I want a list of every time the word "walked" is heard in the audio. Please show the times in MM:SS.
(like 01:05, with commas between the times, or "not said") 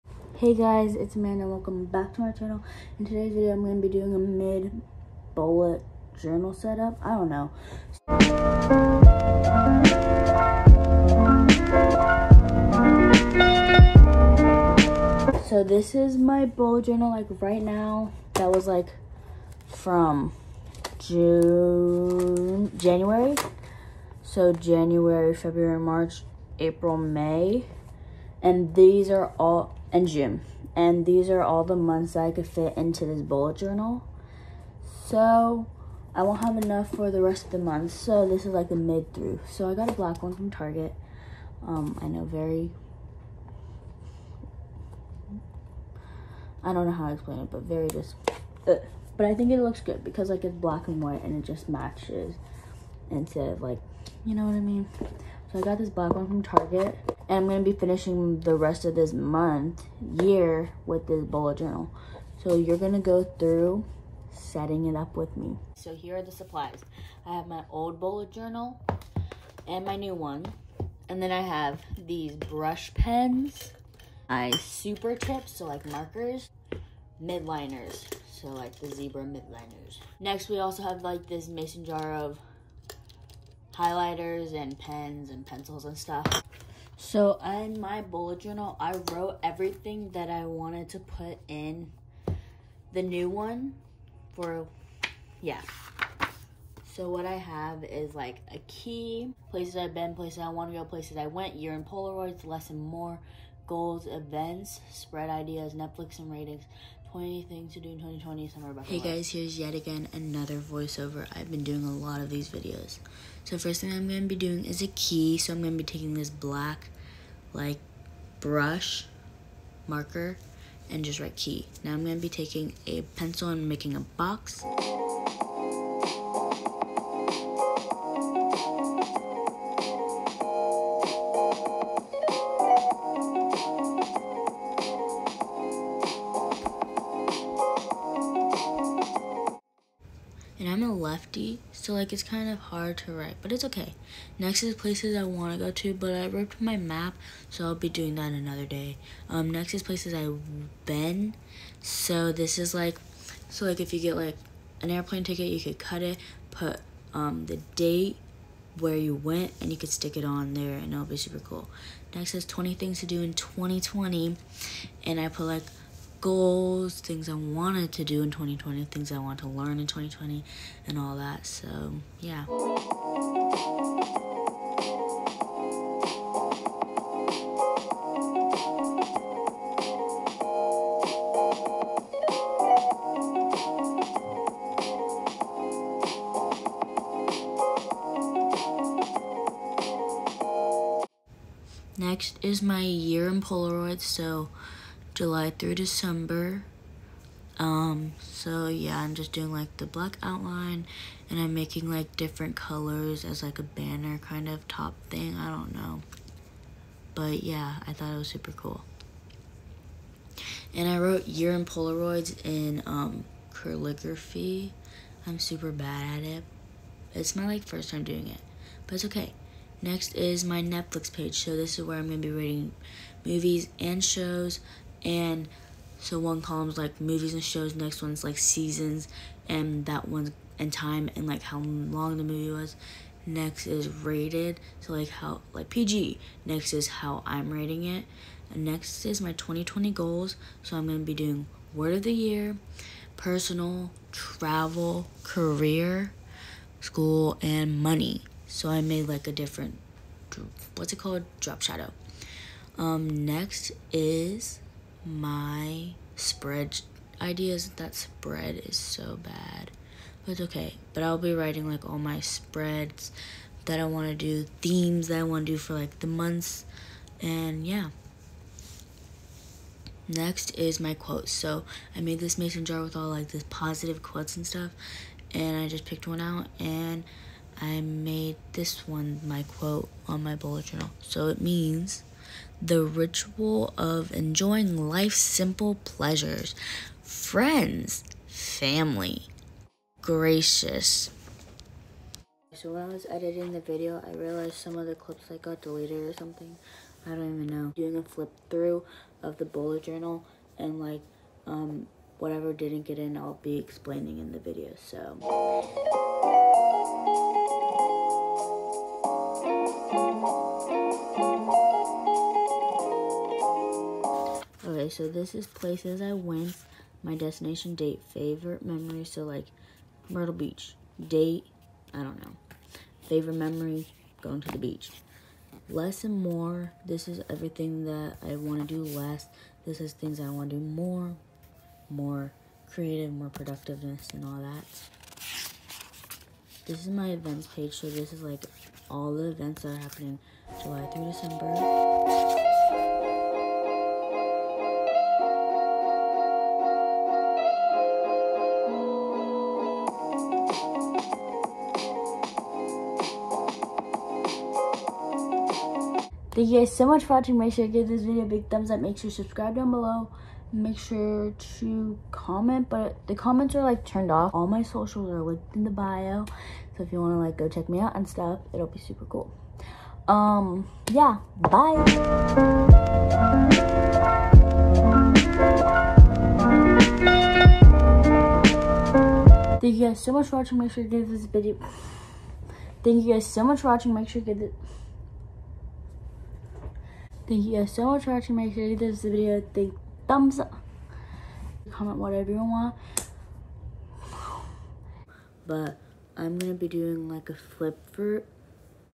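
not said.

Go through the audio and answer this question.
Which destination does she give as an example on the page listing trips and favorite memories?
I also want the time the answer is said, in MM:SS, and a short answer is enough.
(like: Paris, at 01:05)
Myrtle Beach, at 05:20.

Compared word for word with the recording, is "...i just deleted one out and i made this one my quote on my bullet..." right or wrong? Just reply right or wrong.
wrong.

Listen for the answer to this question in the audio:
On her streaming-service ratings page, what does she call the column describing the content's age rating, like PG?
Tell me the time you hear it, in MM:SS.
03:53.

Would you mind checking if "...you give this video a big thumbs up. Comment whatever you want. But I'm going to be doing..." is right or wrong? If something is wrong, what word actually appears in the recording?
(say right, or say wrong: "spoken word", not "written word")
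right.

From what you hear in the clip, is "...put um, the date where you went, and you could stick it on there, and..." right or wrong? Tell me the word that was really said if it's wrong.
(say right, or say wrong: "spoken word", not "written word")
right.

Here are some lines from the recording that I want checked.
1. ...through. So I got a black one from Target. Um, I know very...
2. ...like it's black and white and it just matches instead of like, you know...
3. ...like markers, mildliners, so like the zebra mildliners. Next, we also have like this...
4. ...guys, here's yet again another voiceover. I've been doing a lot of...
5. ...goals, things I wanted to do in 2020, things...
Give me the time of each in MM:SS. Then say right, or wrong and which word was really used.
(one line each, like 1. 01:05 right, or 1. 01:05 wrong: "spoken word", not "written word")
1. 00:39 right
2. 00:50 right
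3. 01:15 right
4. 01:48 right
5. 02:46 right.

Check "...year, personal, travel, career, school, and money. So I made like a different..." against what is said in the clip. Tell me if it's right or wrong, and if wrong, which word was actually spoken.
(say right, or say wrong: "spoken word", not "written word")
right.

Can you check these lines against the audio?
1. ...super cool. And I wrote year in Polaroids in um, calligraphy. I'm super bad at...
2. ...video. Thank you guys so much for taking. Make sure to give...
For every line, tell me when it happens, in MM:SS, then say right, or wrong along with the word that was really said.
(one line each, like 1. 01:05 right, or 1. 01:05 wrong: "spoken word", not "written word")
1. 03:28 right
2. 06:21 wrong: "watching", not "taking".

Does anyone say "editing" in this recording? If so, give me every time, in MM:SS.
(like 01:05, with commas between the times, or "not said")
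04:53.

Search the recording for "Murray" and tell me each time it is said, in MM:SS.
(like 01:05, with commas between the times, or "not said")
not said.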